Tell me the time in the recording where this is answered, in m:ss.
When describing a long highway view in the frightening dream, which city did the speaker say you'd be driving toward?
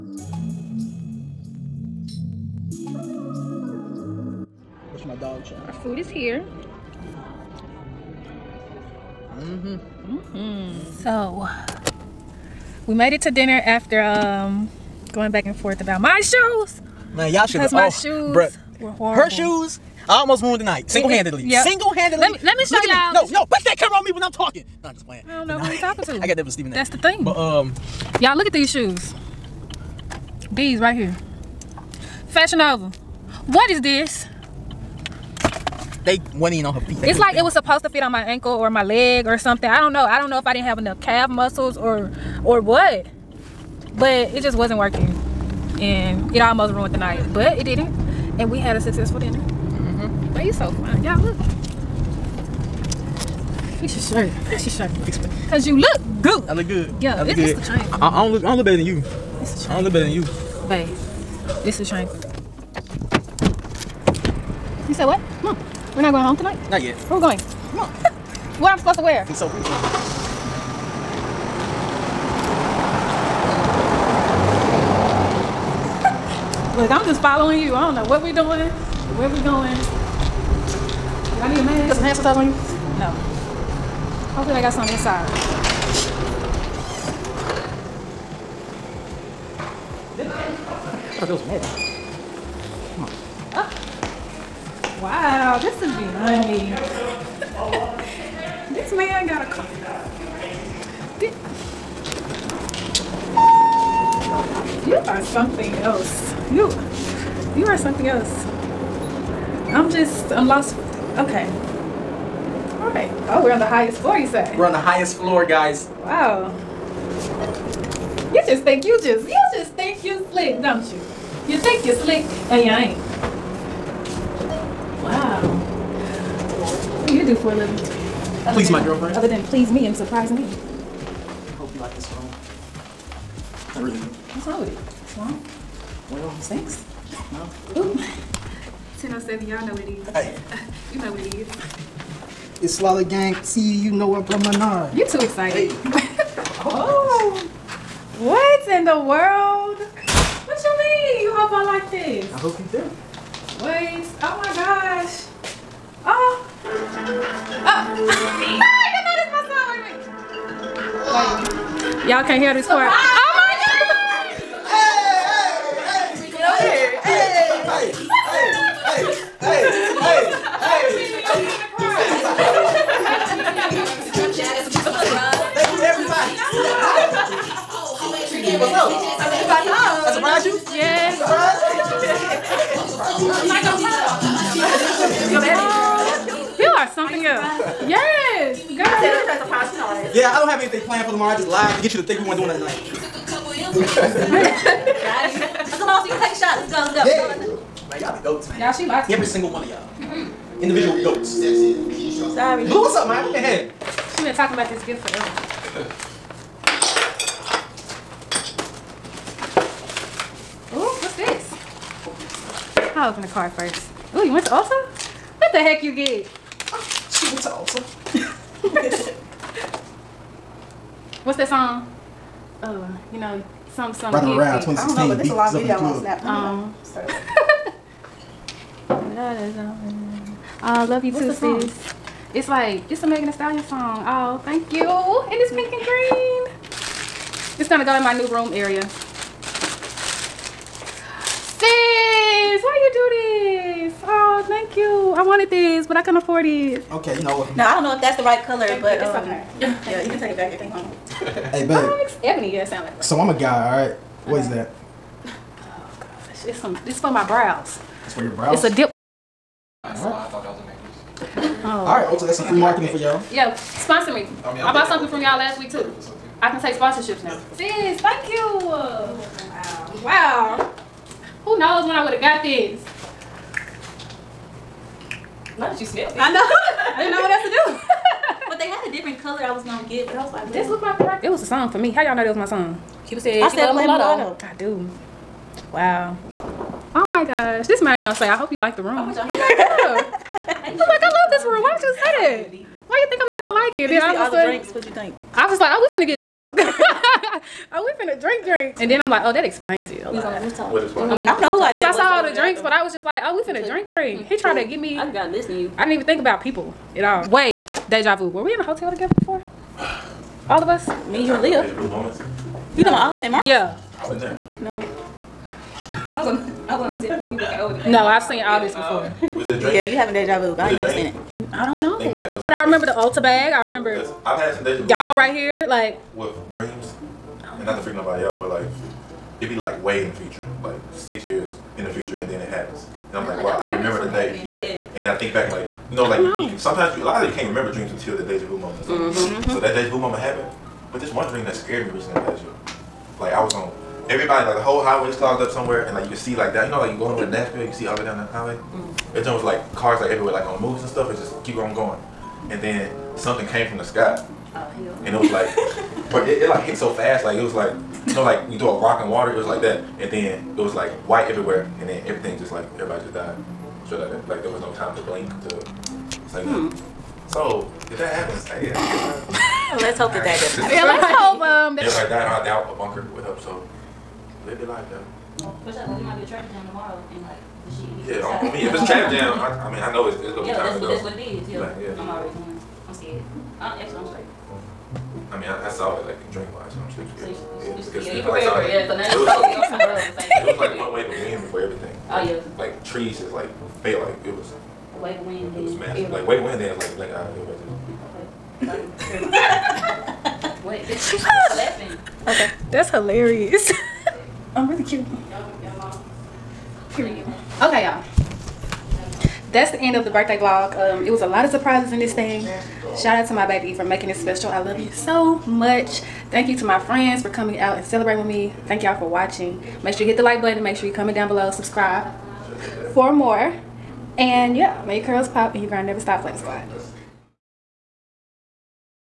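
5:47.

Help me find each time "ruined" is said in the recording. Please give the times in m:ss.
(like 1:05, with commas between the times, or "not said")
0:20, 0:46.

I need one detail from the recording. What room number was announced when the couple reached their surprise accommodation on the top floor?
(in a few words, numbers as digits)
1007.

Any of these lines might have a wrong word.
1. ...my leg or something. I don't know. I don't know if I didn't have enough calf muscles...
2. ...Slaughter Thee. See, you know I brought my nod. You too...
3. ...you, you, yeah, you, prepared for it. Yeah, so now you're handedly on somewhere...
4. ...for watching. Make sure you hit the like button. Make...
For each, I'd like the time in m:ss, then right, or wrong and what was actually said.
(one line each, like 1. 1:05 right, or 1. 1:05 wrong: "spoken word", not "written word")
1. 0:38 right
2. 2:22 wrong: "Gang", not "Thee"
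3. 6:27 wrong: "totally", not "handedly"
4. 6:58 right.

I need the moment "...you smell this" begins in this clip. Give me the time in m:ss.
4:35.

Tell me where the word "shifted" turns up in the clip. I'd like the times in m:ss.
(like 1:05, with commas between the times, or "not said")
not said.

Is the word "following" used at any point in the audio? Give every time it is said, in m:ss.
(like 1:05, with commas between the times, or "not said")
1:17.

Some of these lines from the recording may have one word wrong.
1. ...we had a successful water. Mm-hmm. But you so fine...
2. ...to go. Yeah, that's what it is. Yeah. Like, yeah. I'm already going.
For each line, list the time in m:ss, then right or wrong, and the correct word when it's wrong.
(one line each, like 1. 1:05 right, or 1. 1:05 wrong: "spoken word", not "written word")
1. 0:48 wrong: "dinner", not "water"
2. 6:20 right.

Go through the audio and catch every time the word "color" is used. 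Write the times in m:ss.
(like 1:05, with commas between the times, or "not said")
4:08, 4:39.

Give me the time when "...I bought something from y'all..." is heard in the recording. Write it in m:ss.
4:24.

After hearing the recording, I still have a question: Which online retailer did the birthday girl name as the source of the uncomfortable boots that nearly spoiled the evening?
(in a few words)
Fashion Nova.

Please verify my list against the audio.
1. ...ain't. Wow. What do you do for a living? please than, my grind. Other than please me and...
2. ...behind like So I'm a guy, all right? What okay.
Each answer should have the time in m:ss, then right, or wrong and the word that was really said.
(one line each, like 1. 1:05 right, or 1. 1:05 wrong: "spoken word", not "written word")
1. 2:02 wrong: "girlfriend", not "grind"
2. 4:12 wrong: "sound", not "behind".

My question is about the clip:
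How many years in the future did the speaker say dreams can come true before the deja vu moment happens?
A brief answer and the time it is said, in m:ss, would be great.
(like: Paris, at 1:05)
6, at 5:30.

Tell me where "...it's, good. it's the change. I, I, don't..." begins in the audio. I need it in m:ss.
0:57.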